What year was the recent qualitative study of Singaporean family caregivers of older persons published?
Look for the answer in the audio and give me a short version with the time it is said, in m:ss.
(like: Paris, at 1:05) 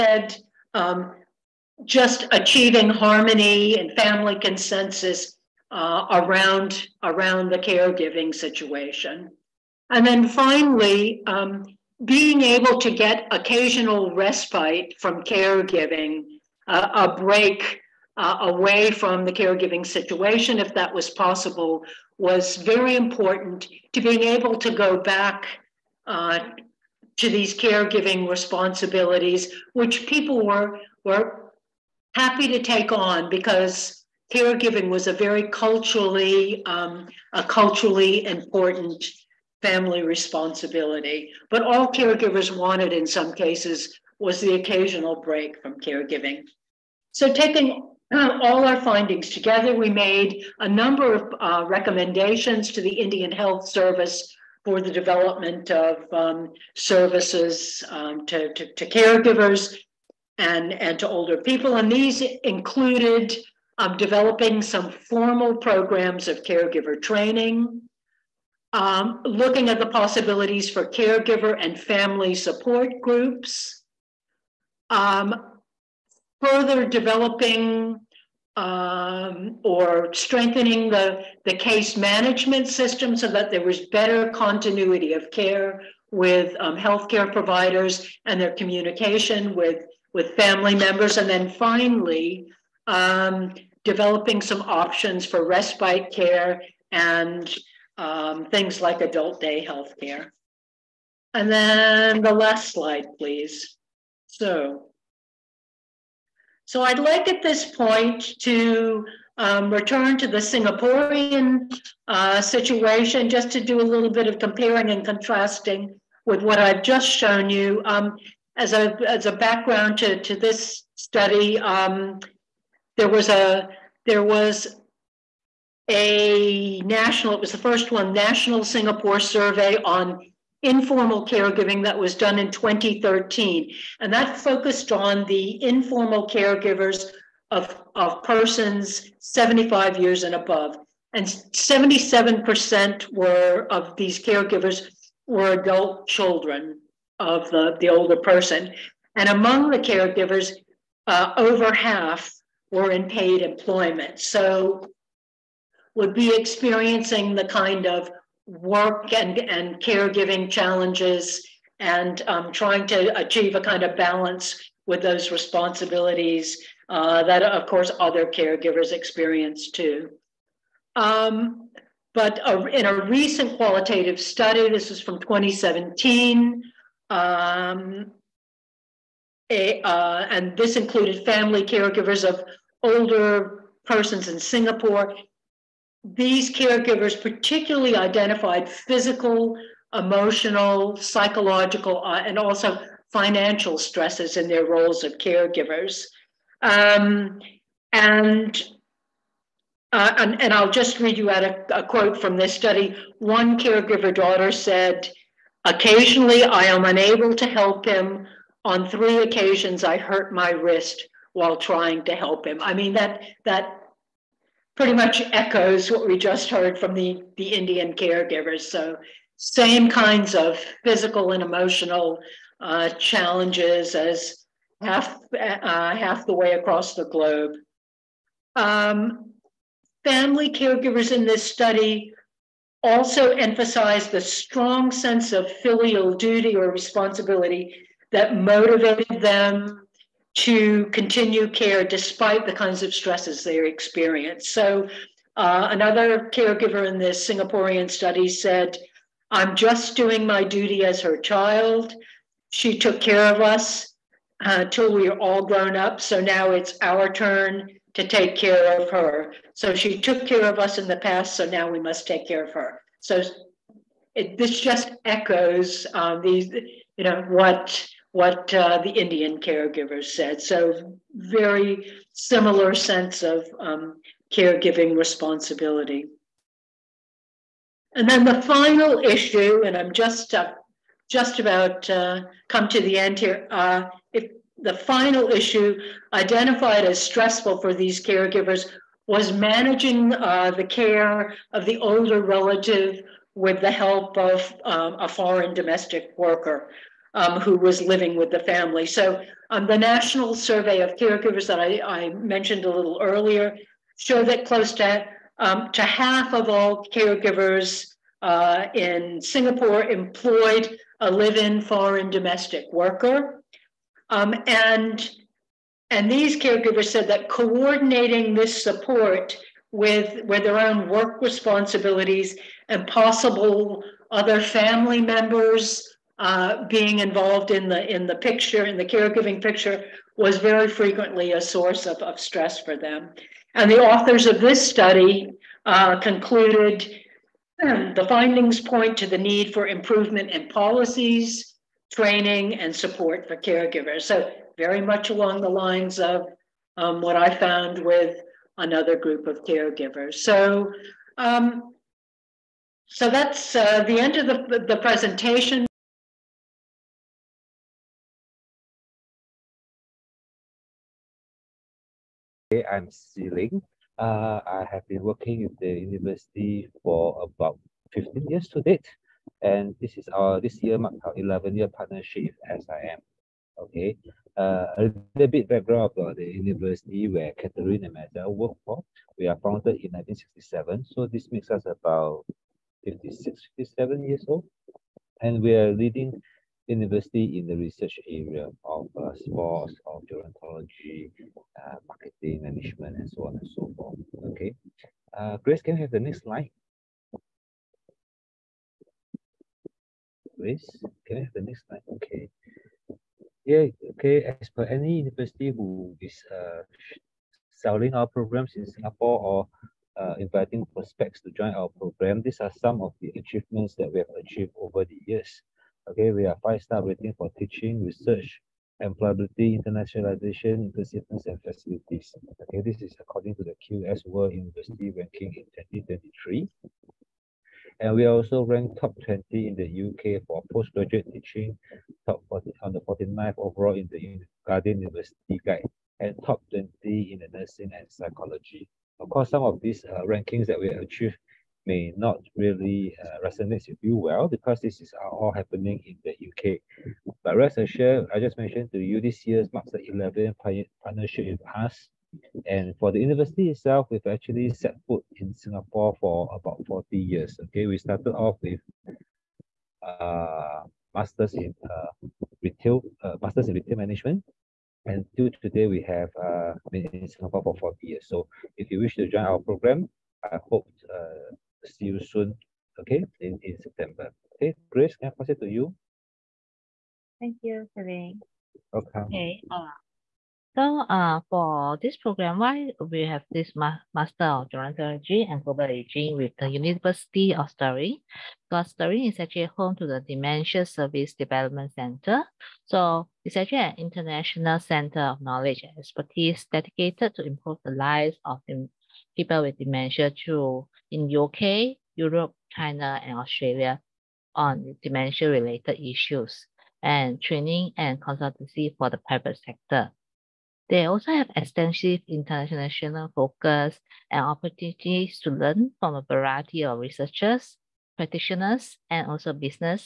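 2017, at 2:55.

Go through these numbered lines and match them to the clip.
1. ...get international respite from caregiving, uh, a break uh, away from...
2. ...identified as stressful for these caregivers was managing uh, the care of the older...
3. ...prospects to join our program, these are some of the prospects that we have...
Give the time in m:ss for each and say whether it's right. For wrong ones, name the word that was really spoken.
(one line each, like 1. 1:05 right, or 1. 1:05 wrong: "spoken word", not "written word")
1. 0:12 wrong: "occasional", not "international"
2. 4:46 right
3. 6:50 wrong: "achievements", not "prospects".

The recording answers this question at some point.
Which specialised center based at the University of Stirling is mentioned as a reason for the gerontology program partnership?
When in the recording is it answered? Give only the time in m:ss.
8:10.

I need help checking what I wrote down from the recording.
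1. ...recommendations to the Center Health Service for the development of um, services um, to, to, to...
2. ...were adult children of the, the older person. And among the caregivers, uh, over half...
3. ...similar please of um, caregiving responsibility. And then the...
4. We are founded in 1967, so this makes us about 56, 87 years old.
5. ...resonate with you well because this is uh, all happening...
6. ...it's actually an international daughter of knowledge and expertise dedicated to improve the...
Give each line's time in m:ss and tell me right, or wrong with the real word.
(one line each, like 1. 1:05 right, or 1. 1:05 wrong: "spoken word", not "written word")
1. 0:51 wrong: "Indian", not "Center"
2. 2:25 right
3. 4:32 wrong: "sense", not "please"
4. 6:19 wrong: "57", not "87"
5. 7:23 right
6. 8:13 wrong: "center", not "daughter".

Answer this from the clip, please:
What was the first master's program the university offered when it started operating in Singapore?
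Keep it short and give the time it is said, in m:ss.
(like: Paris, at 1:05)
Masters in retail management, at 7:43.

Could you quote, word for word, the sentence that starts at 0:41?
But all caregivers wanted in some cases was the occasional break from caregiving.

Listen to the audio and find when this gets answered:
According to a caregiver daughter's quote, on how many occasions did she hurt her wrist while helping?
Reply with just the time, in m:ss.
3:28.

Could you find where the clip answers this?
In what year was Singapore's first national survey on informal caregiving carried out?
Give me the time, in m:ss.
2:12.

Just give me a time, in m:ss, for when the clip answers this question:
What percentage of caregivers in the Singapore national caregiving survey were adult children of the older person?
2:21.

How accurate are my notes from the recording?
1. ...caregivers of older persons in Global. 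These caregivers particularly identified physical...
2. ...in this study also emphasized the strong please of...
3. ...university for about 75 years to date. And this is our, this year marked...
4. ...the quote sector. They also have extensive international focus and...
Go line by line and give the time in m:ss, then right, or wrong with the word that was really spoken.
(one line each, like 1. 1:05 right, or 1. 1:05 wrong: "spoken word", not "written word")
1. 3:01 wrong: "Singapore", not "Global"
2. 3:51 wrong: "sense", not "please"
3. 6:05 wrong: "15", not "75"
4. 8:28 wrong: "private", not "quote".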